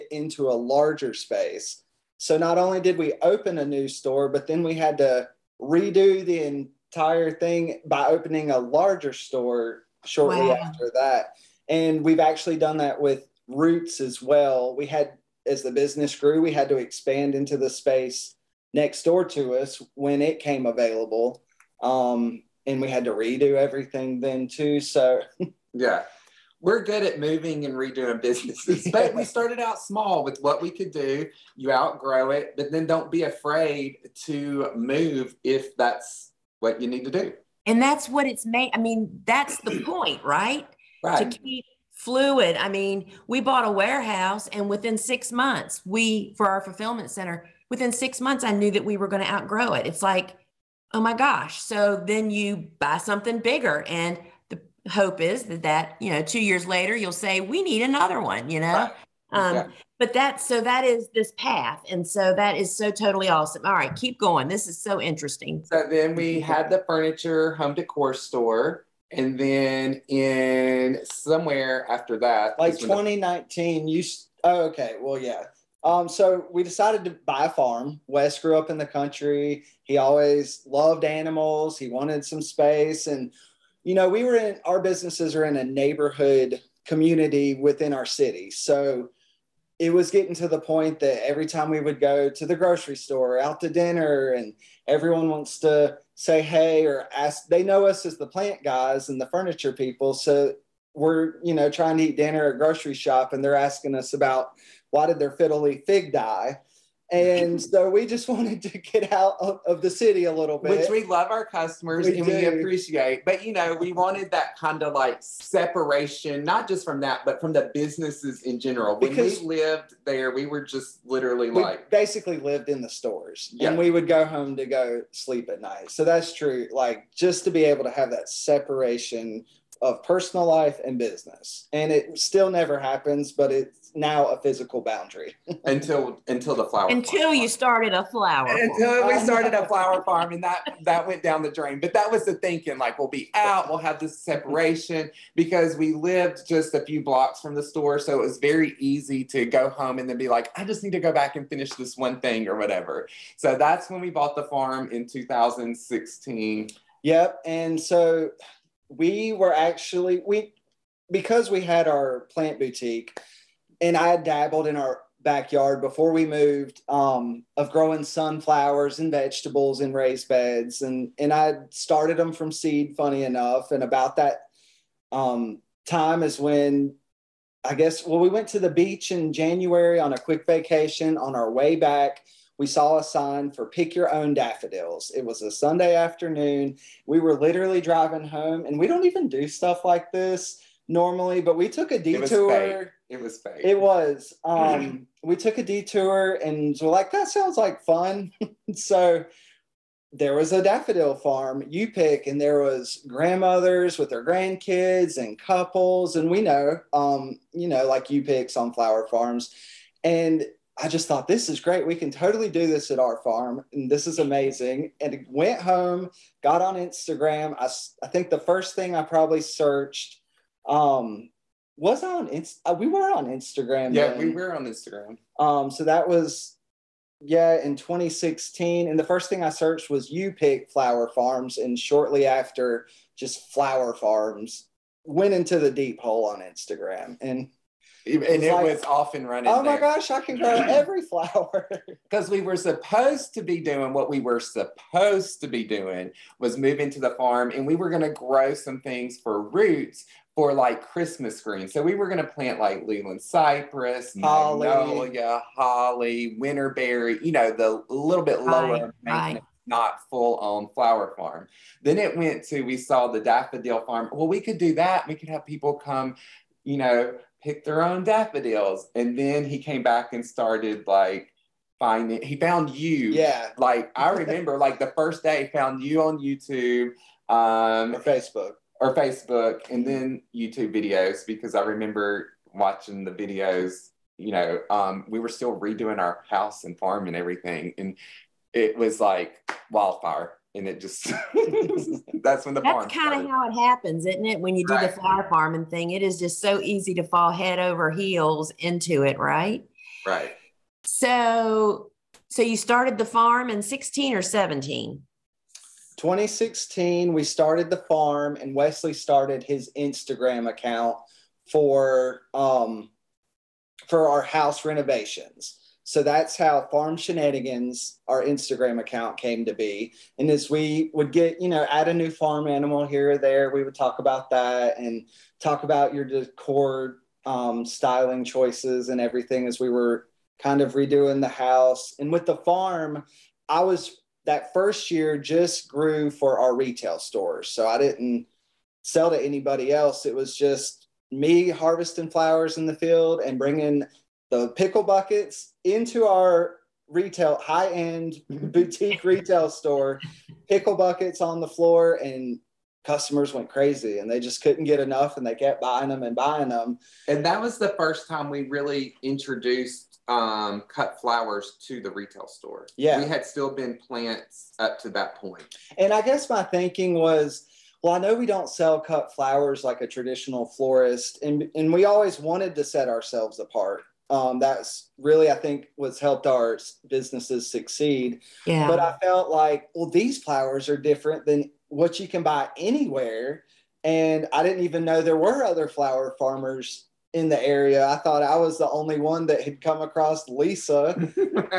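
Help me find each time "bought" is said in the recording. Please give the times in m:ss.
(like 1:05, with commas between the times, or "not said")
0:43, 2:34.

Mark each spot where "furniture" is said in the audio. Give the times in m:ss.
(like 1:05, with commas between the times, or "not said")
1:06, 1:39.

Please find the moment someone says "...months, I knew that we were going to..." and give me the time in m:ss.
0:48.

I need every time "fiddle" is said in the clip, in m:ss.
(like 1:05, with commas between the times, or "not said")
1:45.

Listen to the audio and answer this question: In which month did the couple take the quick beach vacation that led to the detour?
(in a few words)
January.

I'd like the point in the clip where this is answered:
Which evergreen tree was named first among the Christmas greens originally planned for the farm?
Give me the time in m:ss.
4:12.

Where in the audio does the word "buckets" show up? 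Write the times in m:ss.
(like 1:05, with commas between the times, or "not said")
5:44, 5:50.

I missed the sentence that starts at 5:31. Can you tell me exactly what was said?
And with the farm, I was that first year just grew for our retail stores.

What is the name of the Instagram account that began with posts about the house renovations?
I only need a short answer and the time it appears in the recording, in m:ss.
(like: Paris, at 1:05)
Farm Shenanigans, at 5:16.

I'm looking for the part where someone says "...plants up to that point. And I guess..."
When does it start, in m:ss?
6:03.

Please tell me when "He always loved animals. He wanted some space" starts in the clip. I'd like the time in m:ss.
1:19.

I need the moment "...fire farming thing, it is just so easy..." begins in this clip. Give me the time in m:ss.
4:55.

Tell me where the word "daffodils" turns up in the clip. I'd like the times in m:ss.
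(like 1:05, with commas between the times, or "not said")
3:04, 3:20, 4:23, 4:28.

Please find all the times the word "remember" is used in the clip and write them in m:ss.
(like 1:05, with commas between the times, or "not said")
4:34, 4:41.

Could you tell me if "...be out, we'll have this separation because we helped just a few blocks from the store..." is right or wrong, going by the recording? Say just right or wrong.
wrong.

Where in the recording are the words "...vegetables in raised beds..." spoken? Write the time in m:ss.
2:49.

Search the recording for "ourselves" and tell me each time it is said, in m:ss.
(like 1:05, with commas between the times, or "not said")
6:12.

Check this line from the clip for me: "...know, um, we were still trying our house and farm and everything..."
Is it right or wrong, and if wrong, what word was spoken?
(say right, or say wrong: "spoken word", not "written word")
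wrong: "redoing", not "trying".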